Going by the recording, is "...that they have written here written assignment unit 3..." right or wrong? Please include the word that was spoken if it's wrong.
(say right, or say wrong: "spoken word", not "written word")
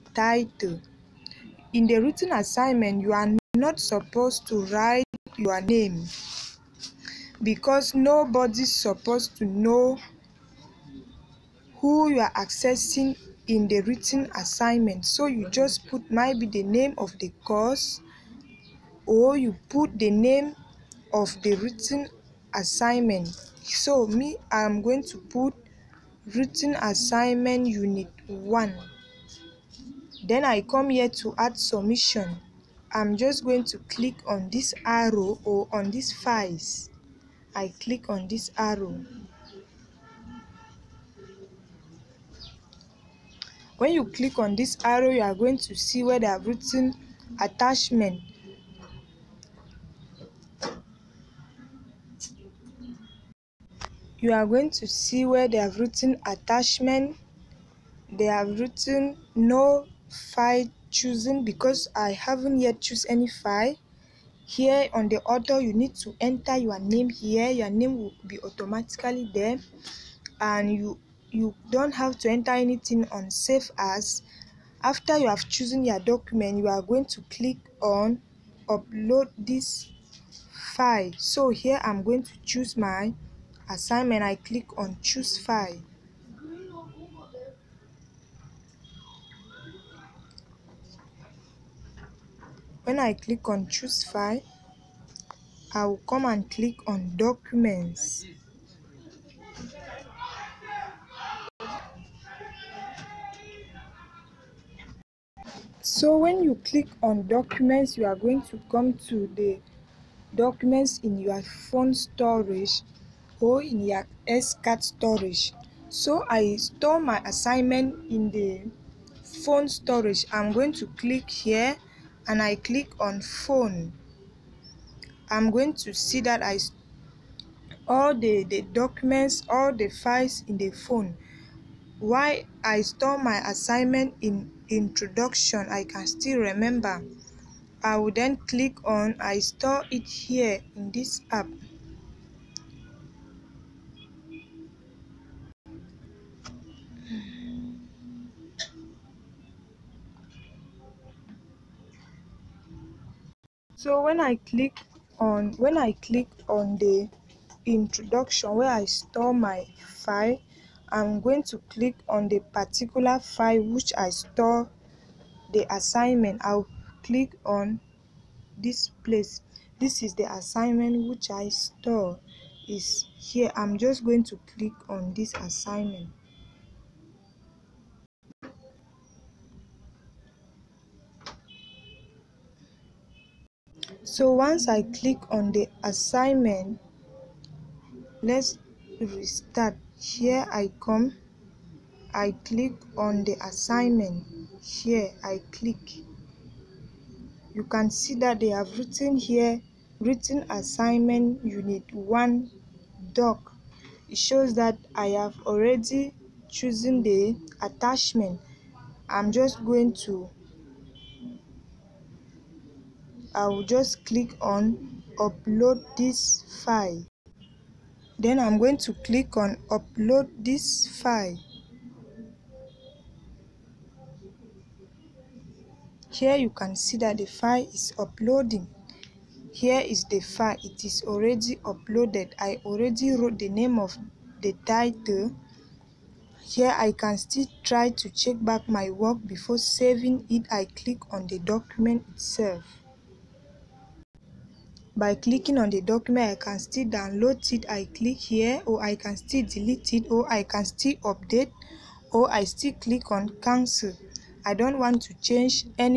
wrong: "1", not "3".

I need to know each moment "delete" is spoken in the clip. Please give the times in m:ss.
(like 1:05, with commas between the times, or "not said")
4:09.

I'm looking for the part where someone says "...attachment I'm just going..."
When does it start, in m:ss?
3:27.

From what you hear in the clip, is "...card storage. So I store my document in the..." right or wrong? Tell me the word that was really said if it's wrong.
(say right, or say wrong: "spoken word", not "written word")
wrong: "assignment", not "document".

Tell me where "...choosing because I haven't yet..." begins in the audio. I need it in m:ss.
1:00.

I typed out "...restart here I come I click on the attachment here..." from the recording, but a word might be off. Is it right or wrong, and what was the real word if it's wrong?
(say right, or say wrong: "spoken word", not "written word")
wrong: "assignment", not "attachment".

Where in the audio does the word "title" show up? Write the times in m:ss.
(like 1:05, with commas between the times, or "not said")
0:00, 3:54.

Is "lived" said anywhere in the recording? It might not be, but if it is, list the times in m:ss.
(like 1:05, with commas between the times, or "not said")
not said.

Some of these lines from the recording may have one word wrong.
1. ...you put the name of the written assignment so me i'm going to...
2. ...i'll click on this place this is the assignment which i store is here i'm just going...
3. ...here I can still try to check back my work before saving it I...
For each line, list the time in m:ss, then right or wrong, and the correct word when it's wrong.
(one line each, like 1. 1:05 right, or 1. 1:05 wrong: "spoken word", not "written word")
1. 0:19 right
2. 2:46 right
3. 3:56 right.